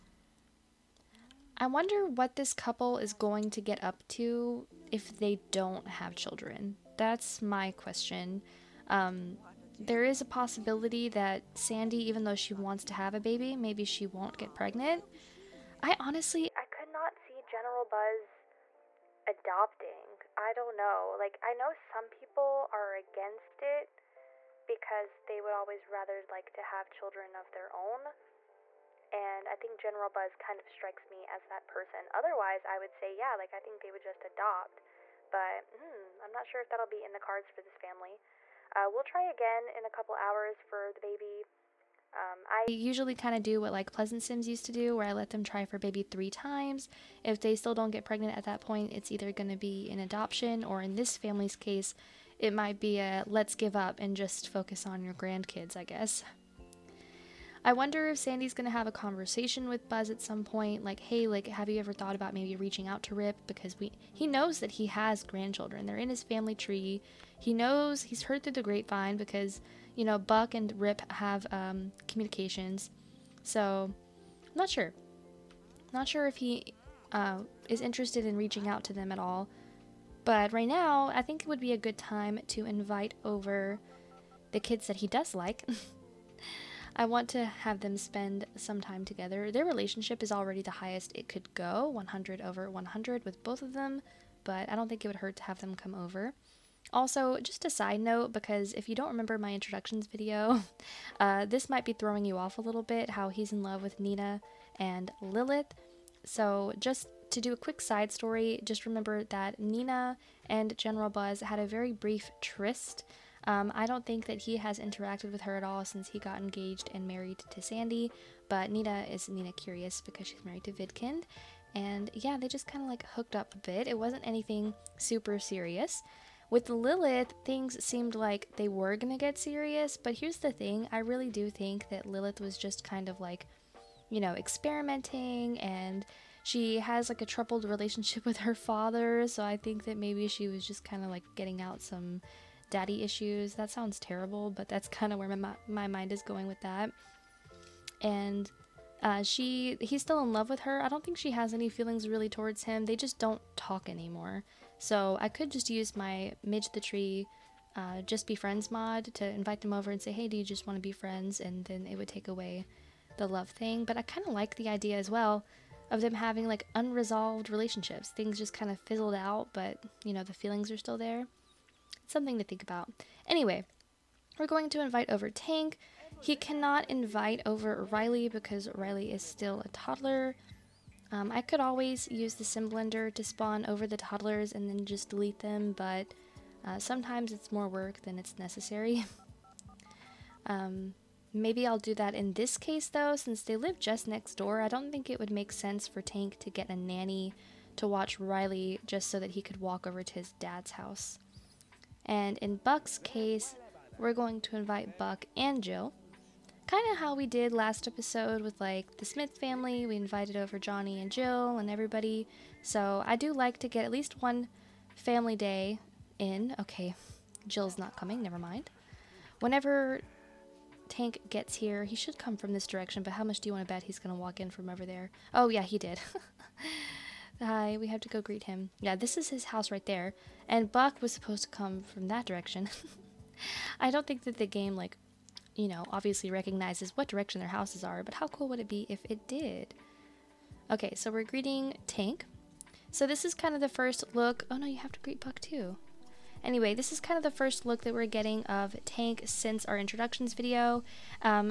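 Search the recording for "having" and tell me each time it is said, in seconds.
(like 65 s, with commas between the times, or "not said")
166 s.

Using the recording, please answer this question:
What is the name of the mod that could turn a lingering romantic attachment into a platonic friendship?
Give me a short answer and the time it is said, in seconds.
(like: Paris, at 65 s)
Just Be Friends, at 158 s.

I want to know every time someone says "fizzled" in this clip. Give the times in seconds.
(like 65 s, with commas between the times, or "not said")
168 s.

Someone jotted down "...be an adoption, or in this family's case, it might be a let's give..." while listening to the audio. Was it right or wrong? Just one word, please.
right.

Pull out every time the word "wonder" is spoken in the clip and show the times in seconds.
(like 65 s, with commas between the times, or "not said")
1 s, 57 s.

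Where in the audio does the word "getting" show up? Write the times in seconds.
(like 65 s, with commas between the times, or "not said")
141 s, 248 s.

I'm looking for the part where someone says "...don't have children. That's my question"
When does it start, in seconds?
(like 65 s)
5 s.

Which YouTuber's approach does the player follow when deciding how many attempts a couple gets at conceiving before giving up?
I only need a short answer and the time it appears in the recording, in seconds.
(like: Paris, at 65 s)
Pleasant Sims, at 43 s.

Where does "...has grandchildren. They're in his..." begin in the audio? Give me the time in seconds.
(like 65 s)
64 s.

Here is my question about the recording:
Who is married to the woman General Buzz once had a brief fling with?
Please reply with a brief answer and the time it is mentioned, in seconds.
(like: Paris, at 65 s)
Vidcund, at 120 s.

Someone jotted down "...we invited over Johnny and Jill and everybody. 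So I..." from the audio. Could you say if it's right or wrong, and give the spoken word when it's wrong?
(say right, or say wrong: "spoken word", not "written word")
right.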